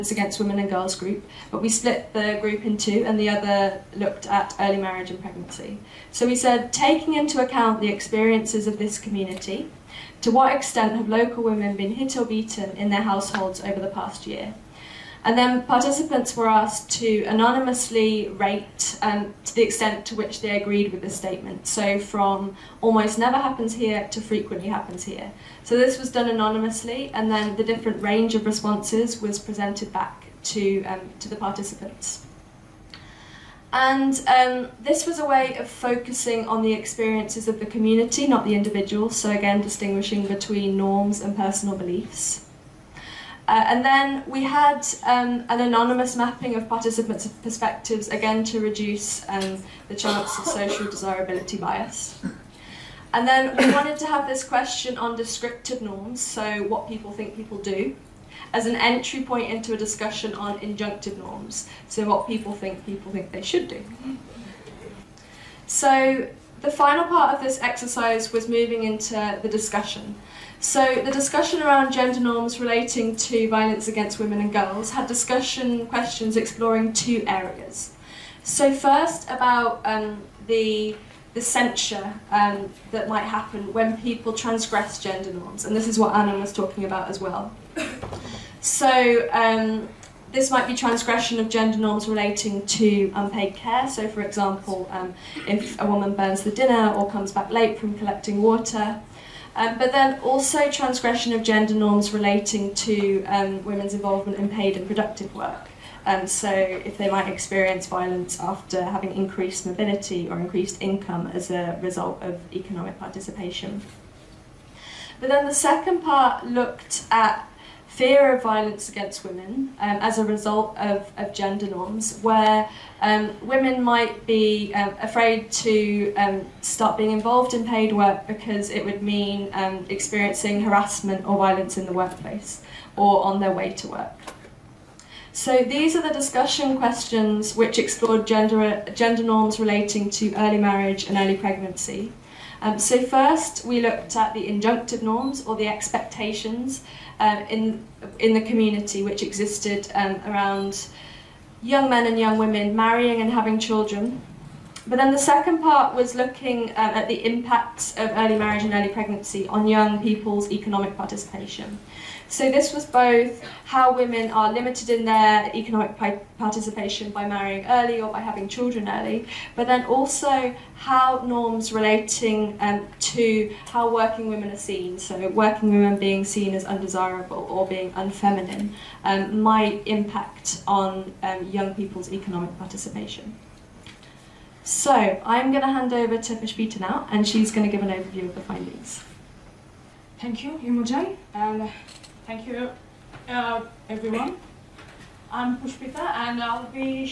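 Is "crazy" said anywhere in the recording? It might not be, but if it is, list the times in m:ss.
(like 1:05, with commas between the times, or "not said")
not said.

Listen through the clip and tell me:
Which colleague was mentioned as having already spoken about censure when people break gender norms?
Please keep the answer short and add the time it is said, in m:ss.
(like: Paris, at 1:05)
Anna, at 1:26.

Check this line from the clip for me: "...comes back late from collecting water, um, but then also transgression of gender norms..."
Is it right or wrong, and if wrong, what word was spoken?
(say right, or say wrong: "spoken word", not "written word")
right.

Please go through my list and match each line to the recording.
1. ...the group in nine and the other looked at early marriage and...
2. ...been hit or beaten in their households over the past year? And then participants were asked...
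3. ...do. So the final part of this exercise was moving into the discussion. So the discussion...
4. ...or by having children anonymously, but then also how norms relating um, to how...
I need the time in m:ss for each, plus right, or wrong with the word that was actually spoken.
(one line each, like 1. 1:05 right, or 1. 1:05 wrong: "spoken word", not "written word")
1. 0:02 wrong: "two", not "nine"
2. 0:11 right
3. 1:03 right
4. 2:48 wrong: "early", not "anonymously".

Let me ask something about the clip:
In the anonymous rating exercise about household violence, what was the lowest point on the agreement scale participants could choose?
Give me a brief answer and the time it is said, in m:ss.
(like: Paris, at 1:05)
Almost never happens here, at 0:22.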